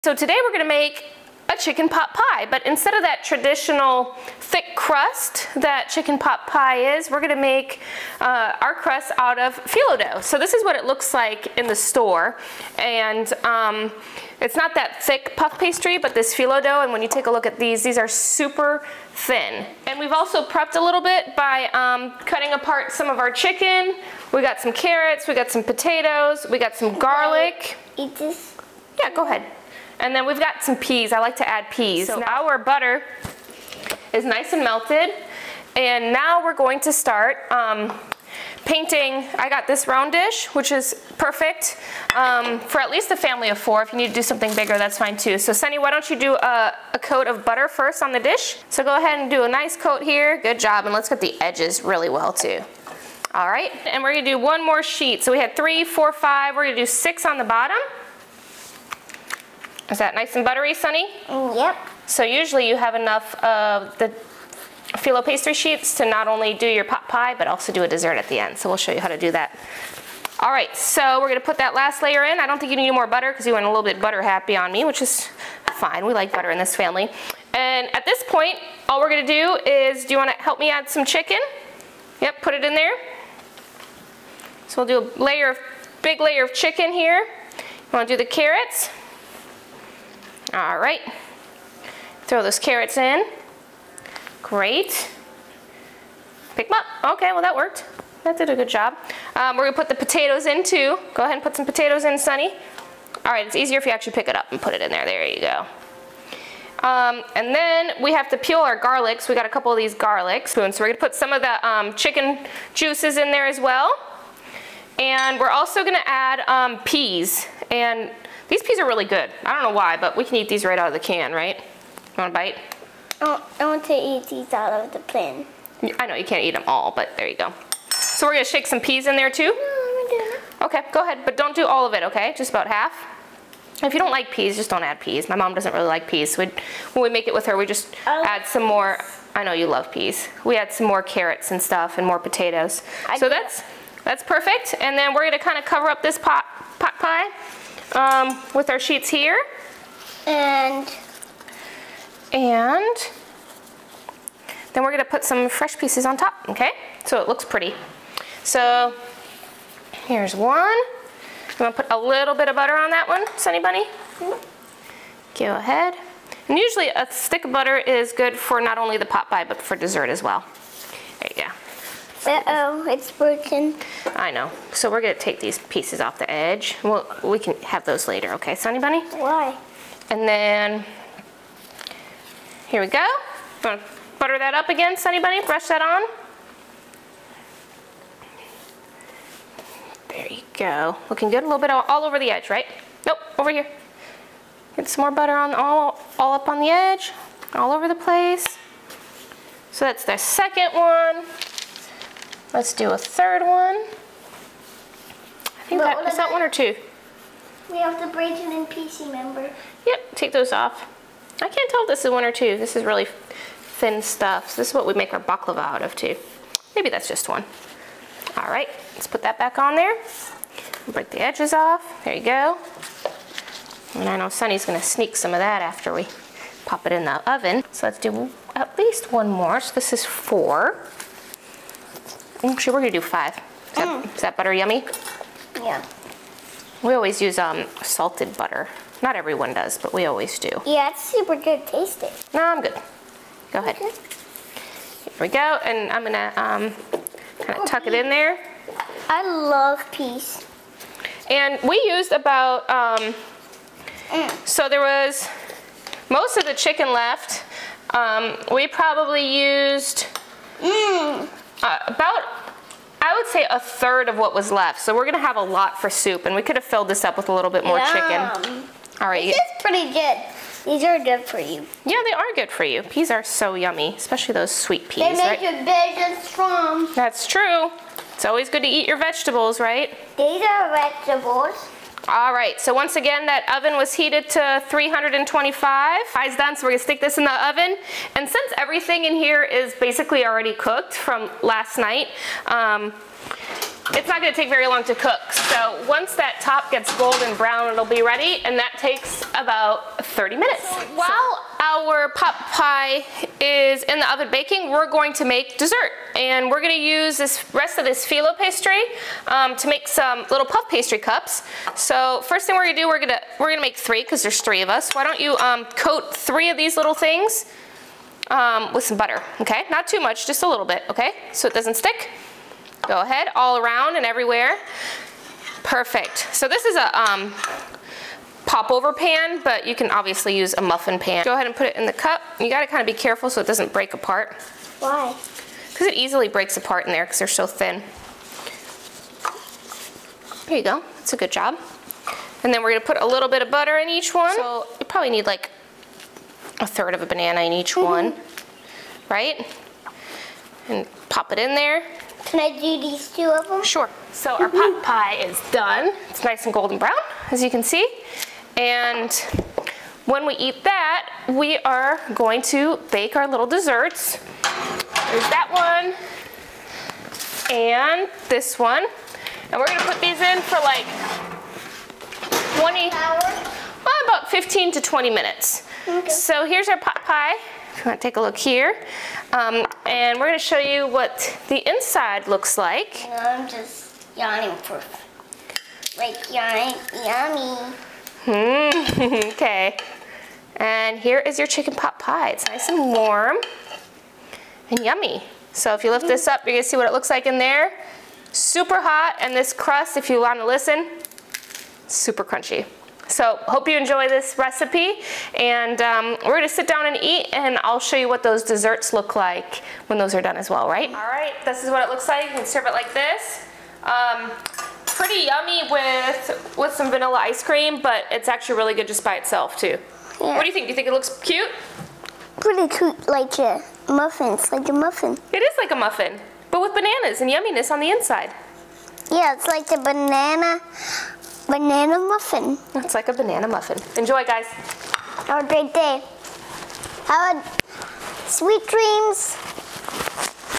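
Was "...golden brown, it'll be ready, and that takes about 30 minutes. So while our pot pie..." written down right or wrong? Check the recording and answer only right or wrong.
right.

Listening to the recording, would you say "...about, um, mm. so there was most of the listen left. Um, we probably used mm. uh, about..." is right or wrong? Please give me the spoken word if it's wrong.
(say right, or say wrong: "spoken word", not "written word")
wrong: "chicken", not "listen".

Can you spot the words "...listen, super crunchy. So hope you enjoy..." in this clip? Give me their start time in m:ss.
6:40.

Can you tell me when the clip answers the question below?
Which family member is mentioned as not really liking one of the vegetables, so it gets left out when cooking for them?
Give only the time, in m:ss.
2:15.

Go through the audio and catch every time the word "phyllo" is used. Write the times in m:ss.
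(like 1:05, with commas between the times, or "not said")
0:09, 0:16, 1:04, 5:08.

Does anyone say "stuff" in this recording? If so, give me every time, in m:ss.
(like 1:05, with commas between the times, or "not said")
2:21, 3:34.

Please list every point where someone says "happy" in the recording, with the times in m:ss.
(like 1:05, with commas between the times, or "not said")
1:14.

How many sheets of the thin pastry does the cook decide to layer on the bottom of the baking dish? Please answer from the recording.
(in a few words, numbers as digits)
6.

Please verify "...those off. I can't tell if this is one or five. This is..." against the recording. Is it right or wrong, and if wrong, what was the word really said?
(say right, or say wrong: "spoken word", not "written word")
wrong: "two", not "five".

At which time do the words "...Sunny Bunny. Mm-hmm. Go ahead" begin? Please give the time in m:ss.
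2:43.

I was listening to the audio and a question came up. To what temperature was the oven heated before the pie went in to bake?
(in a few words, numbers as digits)
325.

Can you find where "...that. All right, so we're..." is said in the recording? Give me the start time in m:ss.
1:09.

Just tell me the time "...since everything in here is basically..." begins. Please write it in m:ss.
4:48.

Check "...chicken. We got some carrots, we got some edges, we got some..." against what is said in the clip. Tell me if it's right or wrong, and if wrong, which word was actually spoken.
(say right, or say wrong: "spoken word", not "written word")
wrong: "potatoes", not "edges".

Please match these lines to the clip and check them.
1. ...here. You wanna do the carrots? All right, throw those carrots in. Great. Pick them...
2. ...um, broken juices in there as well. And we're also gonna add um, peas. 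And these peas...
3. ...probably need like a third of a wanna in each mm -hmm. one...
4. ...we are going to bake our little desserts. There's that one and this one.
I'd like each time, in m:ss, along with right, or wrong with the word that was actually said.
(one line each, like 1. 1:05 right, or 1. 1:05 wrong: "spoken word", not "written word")
1. 1:26 right
2. 1:51 wrong: "chicken", not "broken"
3. 5:44 wrong: "banana", not "wanna"
4. 6:01 right.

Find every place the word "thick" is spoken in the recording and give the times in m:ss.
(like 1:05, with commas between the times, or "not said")
0:04, 0:15.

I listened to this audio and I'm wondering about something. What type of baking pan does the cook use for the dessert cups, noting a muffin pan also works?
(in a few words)
Popover pan.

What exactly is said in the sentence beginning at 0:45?
So Sunny, why don't you do a, a coat of butter first on the dish?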